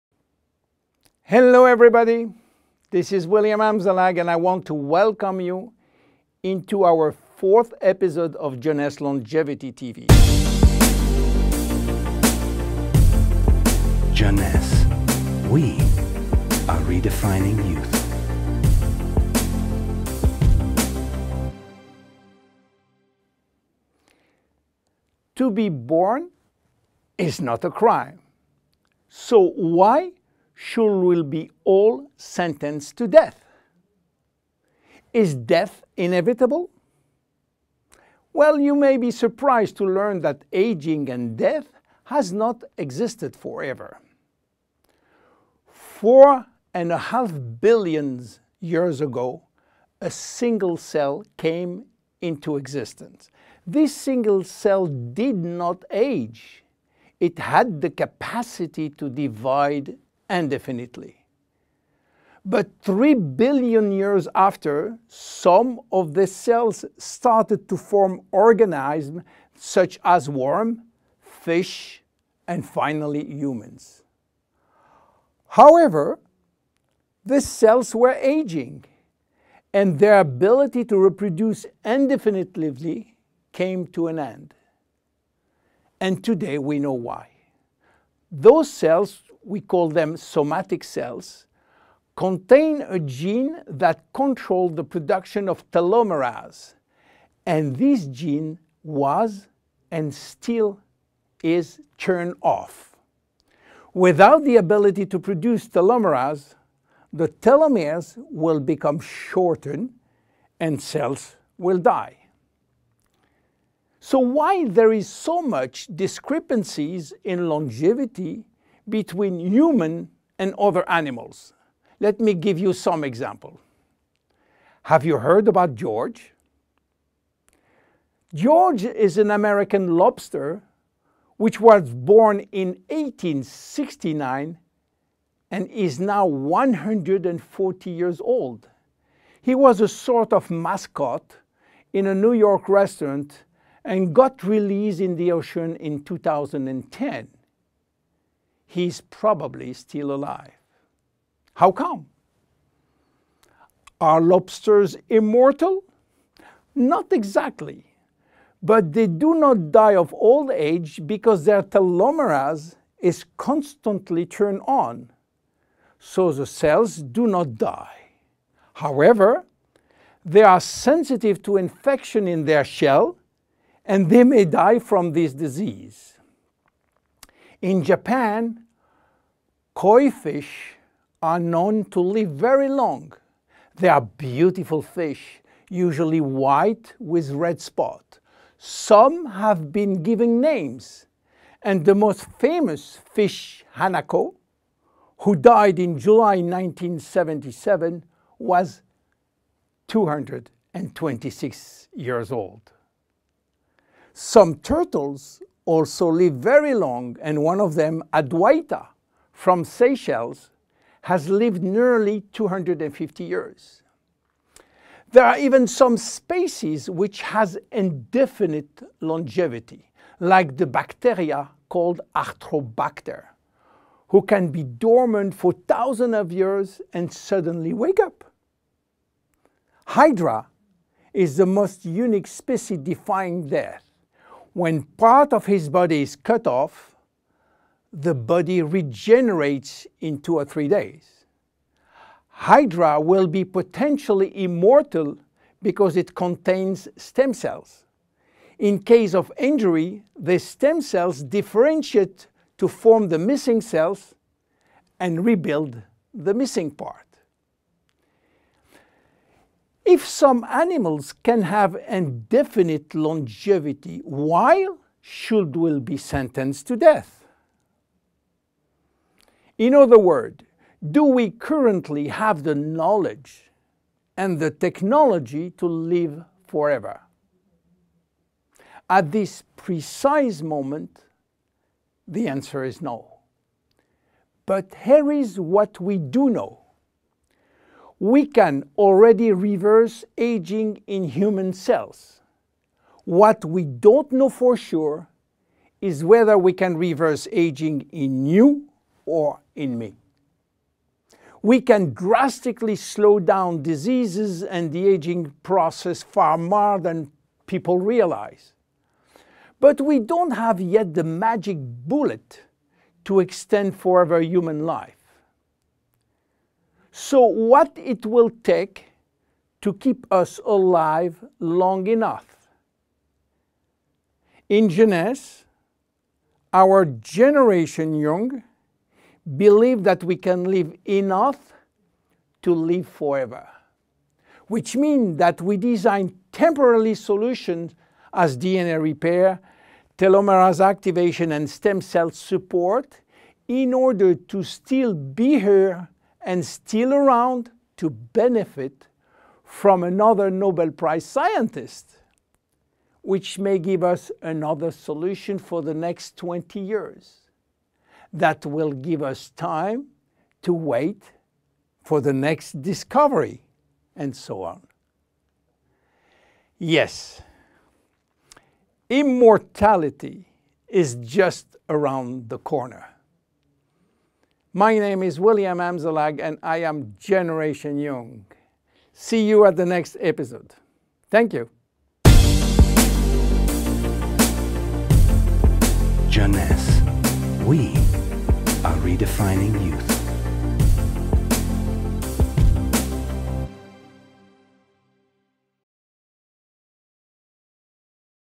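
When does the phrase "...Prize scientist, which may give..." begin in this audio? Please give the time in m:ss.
5:50.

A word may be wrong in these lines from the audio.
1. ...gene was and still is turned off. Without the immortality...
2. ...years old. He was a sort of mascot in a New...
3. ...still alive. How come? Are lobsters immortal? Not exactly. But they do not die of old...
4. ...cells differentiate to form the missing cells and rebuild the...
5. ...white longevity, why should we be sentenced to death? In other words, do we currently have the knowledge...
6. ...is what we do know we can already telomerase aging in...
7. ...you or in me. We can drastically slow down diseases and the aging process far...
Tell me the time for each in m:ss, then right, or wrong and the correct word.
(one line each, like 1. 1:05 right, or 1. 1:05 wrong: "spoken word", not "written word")
1. 1:38 wrong: "ability", not "immortality"
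2. 2:17 right
3. 2:29 right
4. 4:10 right
5. 4:21 wrong: "indefinite", not "white"
6. 4:45 wrong: "reverse", not "telomerase"
7. 4:58 right.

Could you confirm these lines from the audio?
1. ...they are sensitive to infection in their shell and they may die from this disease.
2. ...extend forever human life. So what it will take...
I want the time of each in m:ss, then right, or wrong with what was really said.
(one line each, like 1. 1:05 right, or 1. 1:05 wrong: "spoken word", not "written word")
1. 2:50 right
2. 5:13 right.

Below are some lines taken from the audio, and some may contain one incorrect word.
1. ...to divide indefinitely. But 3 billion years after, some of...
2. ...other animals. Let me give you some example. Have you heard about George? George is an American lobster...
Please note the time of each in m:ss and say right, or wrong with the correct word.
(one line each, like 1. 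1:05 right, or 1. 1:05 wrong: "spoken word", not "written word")
1. 0:58 right
2. 2:00 right.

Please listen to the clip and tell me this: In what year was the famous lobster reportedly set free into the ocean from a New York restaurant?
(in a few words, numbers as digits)
2010.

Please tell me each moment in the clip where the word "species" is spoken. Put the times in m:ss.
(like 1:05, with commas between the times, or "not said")
3:35, 3:52.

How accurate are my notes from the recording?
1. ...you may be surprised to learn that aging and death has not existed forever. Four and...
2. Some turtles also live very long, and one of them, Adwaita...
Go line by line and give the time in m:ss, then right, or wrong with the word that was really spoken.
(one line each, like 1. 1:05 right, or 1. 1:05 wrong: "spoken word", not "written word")
1. 0:38 right
2. 3:24 right.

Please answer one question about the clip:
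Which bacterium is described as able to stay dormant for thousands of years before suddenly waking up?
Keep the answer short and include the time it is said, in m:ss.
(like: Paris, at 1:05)
Arthrobacter, at 3:42.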